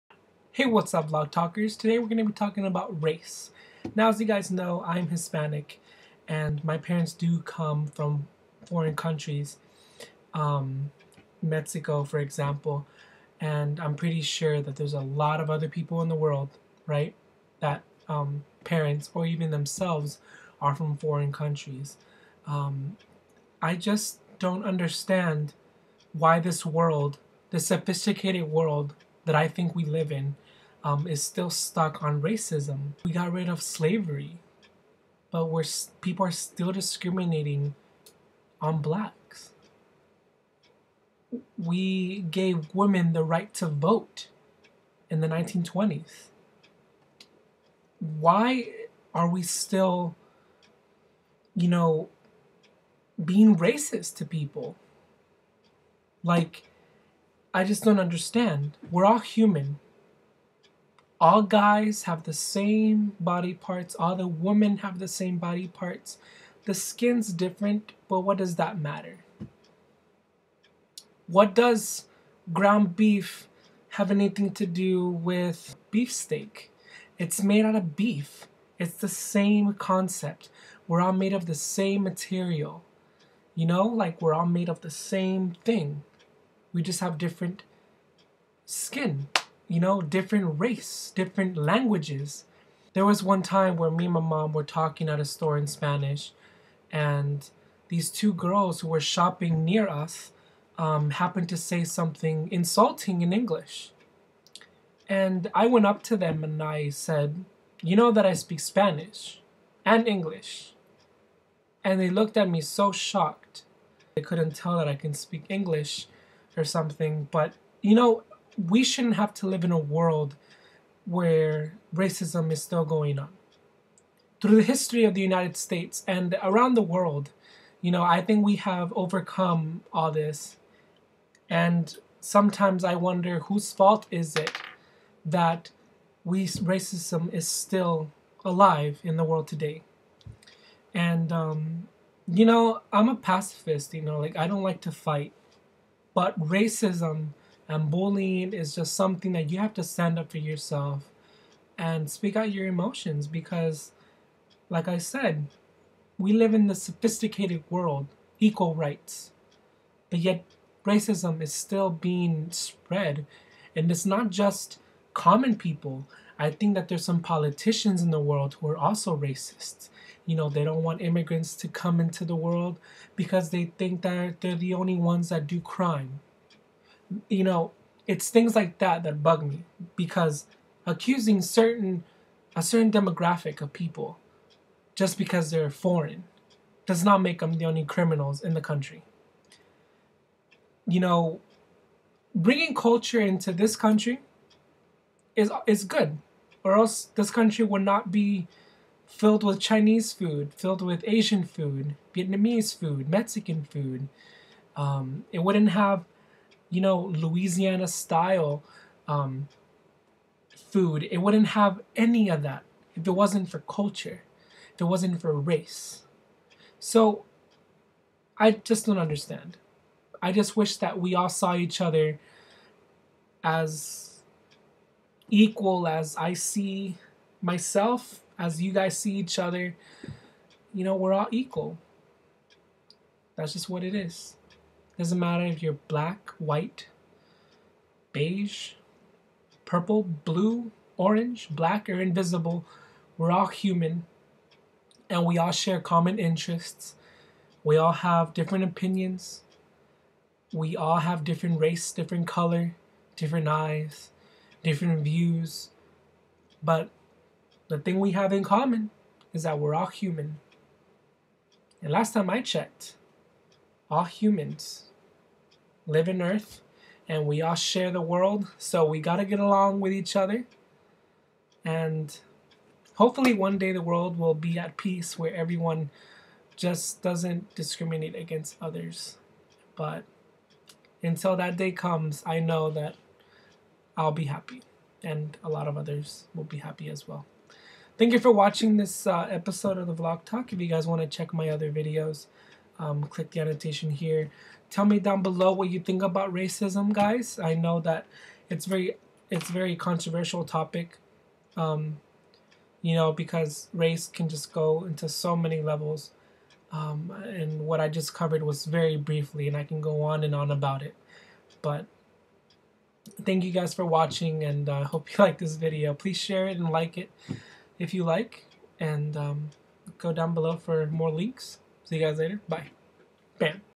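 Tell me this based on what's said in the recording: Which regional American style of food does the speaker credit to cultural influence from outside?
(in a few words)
Louisiana style.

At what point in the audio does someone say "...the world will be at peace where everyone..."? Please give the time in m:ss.
4:33.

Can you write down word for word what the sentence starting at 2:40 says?
But yet, racism is still being spread.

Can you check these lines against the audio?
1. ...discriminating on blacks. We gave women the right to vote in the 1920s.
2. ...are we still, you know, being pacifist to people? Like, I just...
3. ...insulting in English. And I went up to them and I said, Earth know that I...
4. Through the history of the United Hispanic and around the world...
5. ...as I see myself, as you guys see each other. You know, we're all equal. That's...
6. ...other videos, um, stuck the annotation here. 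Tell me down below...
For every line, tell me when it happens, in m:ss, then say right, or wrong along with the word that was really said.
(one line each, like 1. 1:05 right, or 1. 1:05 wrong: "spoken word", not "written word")
1. 0:36 right
2. 0:49 wrong: "racist", not "pacifist"
3. 1:42 wrong: "You", not "Earth"
4. 2:04 wrong: "States", not "Hispanic"
5. 3:45 right
6. 4:51 wrong: "click", not "stuck".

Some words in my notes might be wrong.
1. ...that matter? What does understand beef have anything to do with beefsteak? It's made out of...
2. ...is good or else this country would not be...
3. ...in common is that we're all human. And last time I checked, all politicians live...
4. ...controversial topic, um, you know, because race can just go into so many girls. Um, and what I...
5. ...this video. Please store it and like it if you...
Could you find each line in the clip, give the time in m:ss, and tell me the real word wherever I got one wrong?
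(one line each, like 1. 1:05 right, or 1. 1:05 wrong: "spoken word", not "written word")
1. 1:08 wrong: "ground", not "understand"
2. 3:15 right
3. 4:18 wrong: "humans", not "politicians"
4. 4:59 wrong: "levels", not "girls"
5. 5:15 wrong: "share", not "store".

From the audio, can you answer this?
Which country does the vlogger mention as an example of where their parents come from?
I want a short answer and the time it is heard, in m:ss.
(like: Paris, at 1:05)
Mexico, at 0:11.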